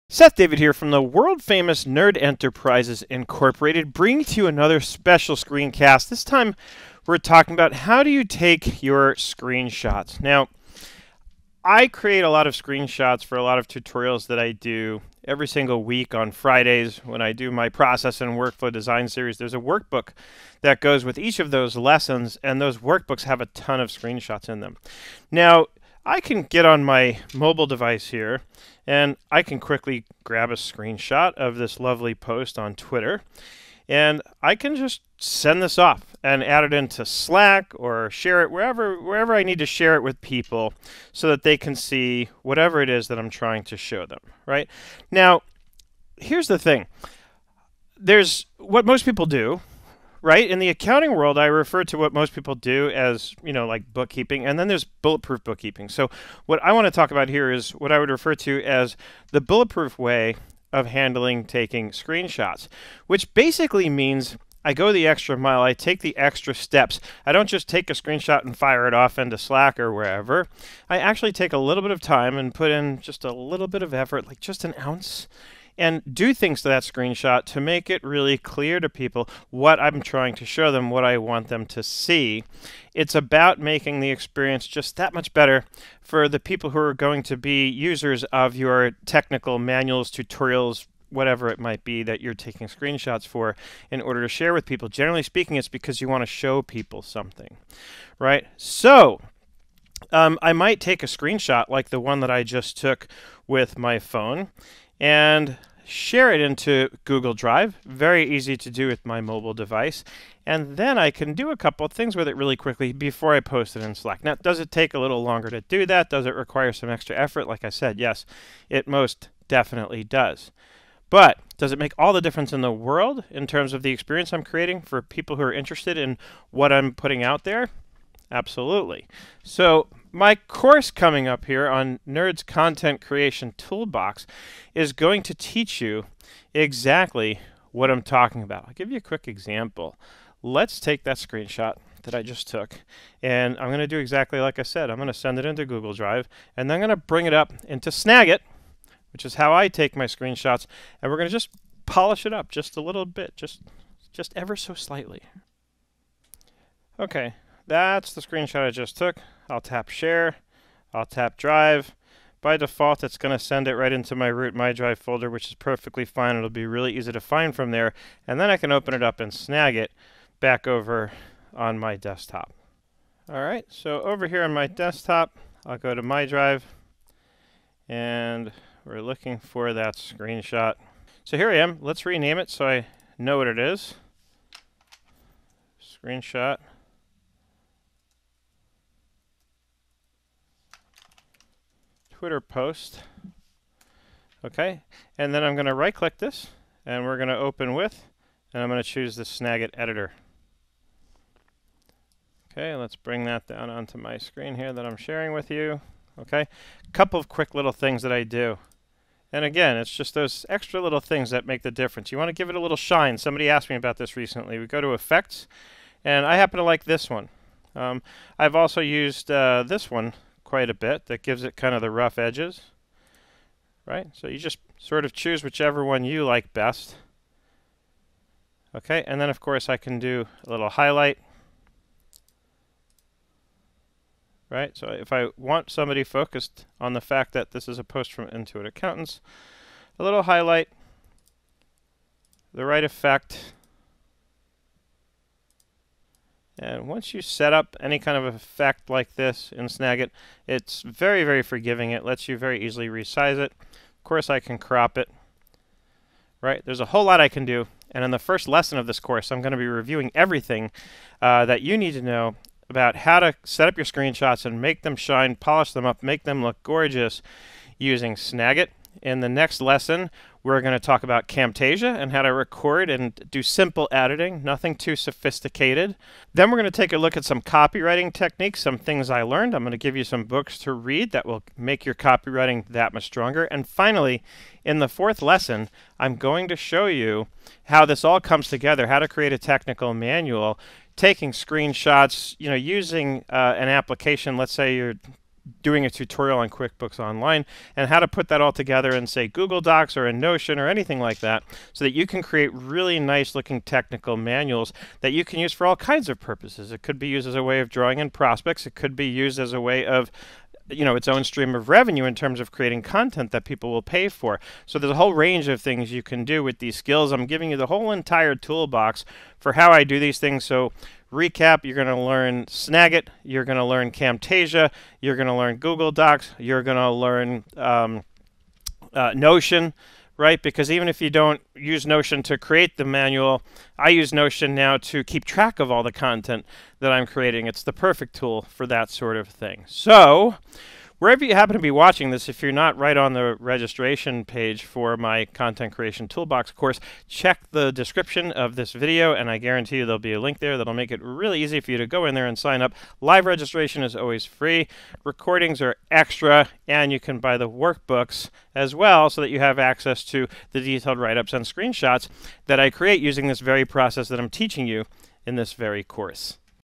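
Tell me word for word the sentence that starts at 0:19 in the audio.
There's a workbook that goes with each of those lessons, and those workbooks have a ton of screenshots in them.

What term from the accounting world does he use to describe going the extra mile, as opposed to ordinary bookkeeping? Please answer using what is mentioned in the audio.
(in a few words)
bulletproof bookkeeping.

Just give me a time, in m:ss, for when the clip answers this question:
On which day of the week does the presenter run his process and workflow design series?
0:16.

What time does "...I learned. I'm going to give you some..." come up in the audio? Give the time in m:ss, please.
4:39.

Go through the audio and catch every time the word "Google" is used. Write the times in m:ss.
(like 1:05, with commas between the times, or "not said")
1:47, 2:25, 4:59, 5:25.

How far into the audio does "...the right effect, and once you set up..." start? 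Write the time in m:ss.
4:02.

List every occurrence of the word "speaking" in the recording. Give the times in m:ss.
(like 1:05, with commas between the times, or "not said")
1:35.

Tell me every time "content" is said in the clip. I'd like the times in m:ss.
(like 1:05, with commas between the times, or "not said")
2:12, 5:12, 5:35, 5:45.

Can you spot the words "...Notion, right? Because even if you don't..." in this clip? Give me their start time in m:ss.
5:29.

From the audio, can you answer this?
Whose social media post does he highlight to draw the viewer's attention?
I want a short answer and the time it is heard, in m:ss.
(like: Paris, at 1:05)
Intuit Accountants, at 3:58.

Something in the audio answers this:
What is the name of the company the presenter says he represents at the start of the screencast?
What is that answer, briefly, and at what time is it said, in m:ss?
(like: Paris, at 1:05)
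Nerd Enterprises Incorporated, at 0:01.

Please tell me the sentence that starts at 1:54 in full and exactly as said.
Now, does it take a little longer to do that?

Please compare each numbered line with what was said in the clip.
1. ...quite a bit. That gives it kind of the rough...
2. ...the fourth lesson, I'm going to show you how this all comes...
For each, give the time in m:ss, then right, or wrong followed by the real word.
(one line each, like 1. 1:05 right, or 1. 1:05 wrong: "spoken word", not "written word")
1. 3:40 right
2. 4:44 right.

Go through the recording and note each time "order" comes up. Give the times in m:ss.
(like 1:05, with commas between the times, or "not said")
1:34.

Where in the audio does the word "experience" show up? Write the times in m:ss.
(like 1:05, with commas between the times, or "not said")
1:24, 2:03.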